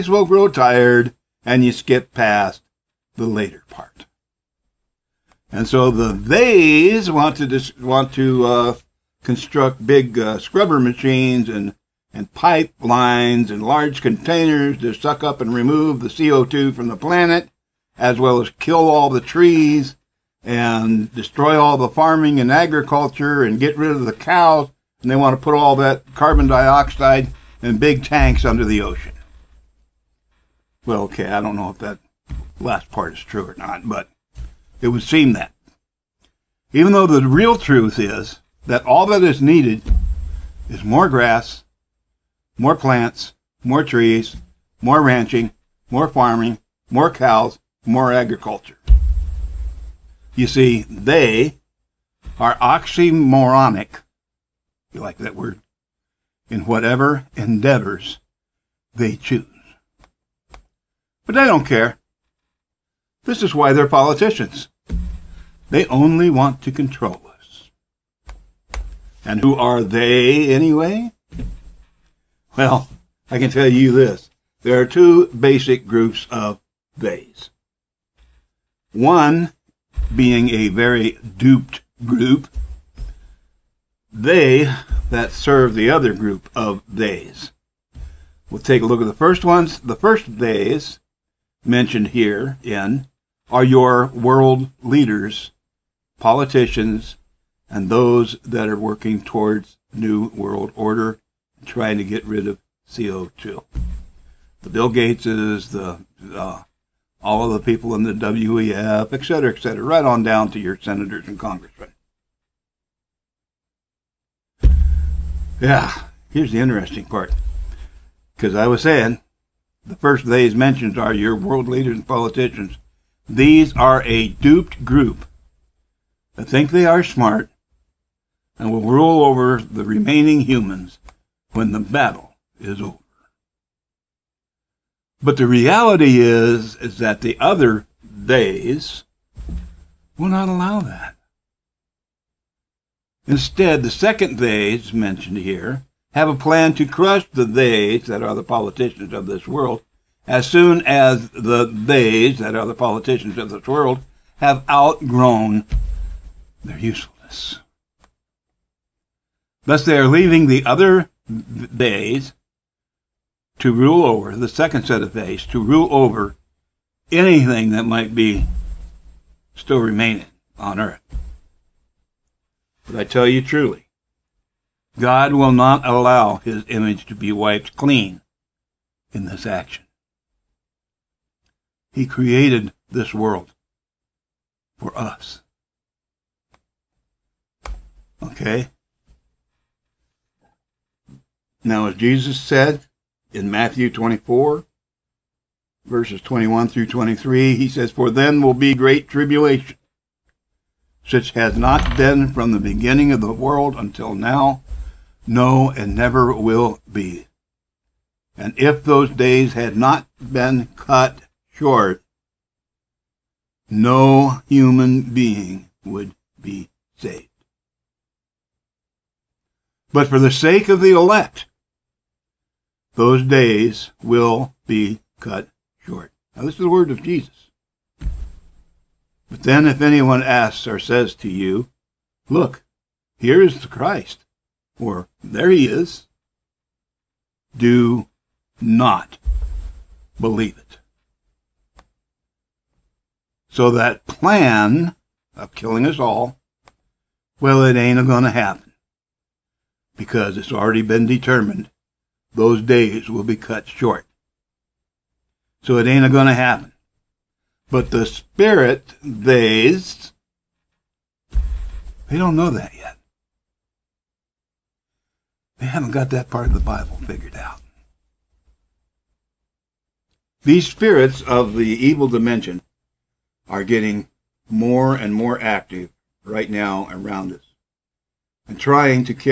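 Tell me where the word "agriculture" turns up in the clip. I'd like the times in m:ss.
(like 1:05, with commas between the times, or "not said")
0:22, 0:48.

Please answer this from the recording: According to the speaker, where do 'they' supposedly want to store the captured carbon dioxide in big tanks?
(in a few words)
Under the ocean.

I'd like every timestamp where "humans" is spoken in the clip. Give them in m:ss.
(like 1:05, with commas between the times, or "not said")
2:10, 3:34.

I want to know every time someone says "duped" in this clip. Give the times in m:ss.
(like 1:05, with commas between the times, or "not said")
1:21, 2:04.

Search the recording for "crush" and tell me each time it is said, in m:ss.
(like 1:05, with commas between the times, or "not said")
2:26.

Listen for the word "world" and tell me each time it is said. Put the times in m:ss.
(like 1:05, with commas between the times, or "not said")
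1:34, 1:40, 2:01, 2:29, 2:33, 3:03, 3:23.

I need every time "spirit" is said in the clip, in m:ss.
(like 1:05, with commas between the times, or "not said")
4:18, 4:30.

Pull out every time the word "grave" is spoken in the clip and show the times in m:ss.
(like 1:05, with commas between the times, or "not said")
not said.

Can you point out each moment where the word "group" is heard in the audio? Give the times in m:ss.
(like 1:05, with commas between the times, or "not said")
1:15, 1:22, 1:26, 2:04.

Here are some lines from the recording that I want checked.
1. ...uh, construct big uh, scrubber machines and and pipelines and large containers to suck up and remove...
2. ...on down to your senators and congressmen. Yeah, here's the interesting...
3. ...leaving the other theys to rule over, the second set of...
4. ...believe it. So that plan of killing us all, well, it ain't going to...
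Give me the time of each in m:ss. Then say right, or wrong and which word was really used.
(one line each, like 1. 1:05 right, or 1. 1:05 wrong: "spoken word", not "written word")
1. 0:08 right
2. 1:50 right
3. 2:40 right
4. 4:00 right.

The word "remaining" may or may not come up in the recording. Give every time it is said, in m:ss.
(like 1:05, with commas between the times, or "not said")
2:09, 2:49.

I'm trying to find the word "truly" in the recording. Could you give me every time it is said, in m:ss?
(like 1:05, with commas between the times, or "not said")
2:53.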